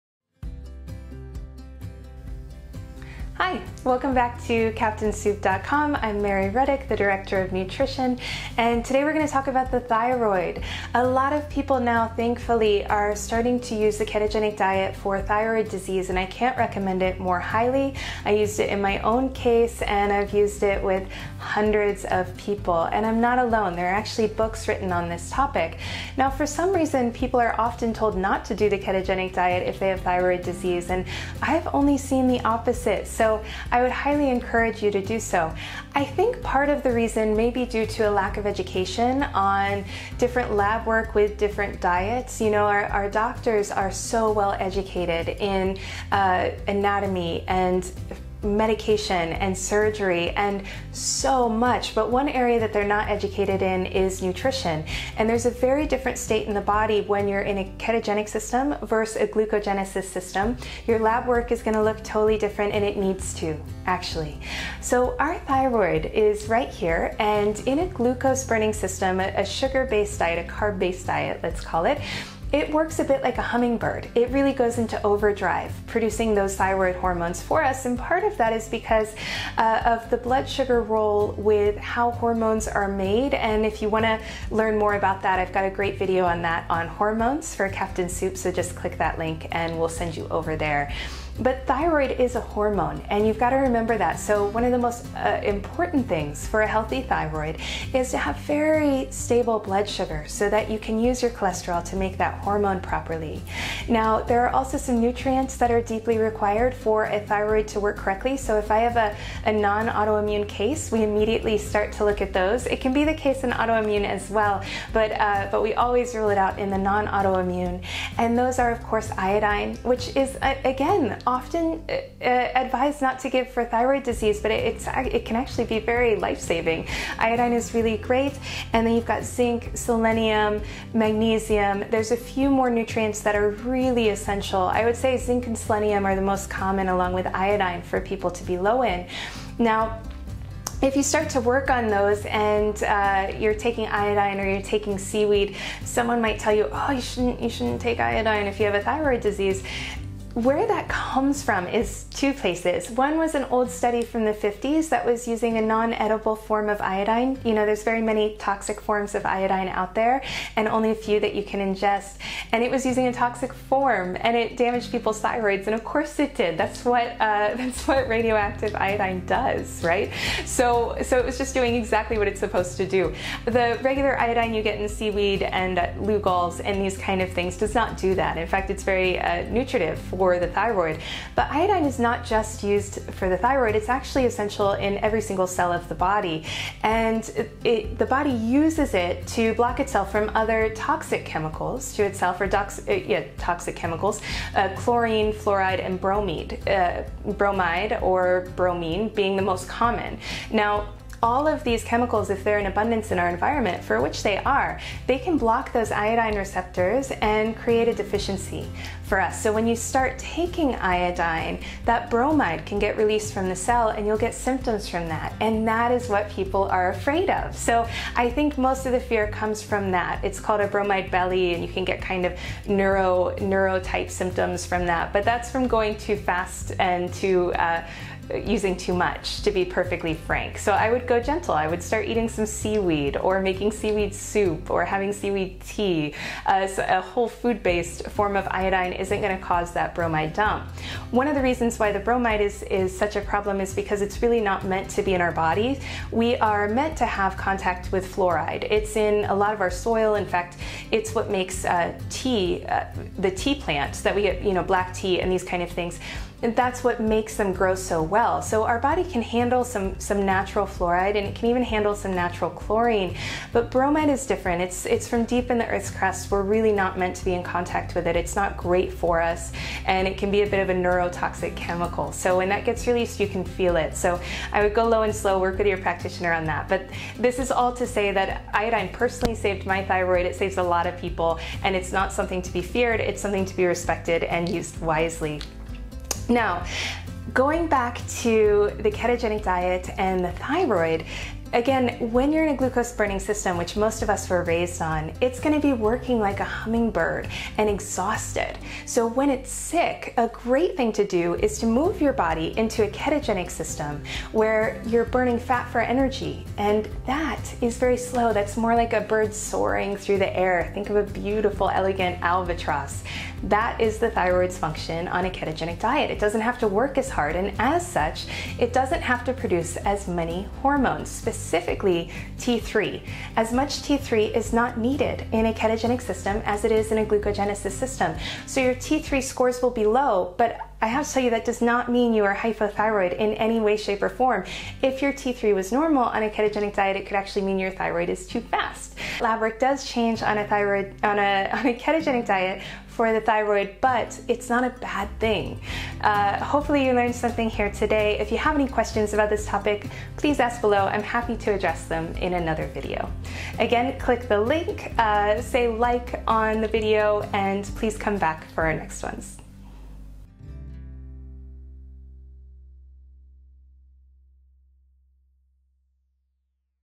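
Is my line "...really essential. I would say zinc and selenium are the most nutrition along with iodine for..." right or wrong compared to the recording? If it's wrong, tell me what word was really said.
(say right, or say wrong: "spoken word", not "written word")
wrong: "common", not "nutrition".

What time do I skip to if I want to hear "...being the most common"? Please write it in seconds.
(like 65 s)
199 s.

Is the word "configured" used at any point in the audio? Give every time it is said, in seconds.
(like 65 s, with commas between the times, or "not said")
not said.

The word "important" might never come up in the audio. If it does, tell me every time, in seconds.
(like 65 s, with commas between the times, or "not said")
95 s.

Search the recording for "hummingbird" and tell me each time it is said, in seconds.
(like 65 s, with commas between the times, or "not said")
73 s, 296 s.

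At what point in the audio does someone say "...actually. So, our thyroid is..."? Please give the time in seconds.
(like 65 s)
63 s.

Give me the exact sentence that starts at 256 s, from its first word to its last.
And that's what makes them grow so well well.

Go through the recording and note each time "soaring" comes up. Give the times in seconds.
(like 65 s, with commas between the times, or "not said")
309 s.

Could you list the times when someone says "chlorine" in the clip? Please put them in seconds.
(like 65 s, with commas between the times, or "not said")
194 s, 262 s.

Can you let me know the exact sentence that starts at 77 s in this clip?
And part of that is because uh, of the blood sugar role with how hormones are made.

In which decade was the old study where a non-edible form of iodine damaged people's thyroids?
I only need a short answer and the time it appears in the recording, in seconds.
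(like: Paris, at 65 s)
1950s, at 154 s.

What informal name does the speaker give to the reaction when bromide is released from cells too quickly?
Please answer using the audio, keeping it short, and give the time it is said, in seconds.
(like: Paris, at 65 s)
Bromide belly, at 220 s.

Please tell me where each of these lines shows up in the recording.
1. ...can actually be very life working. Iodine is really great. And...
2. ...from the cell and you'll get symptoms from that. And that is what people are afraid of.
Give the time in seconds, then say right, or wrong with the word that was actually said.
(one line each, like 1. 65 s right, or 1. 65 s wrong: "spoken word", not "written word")
1. 125 s wrong: "saving", not "working"
2. 213 s right.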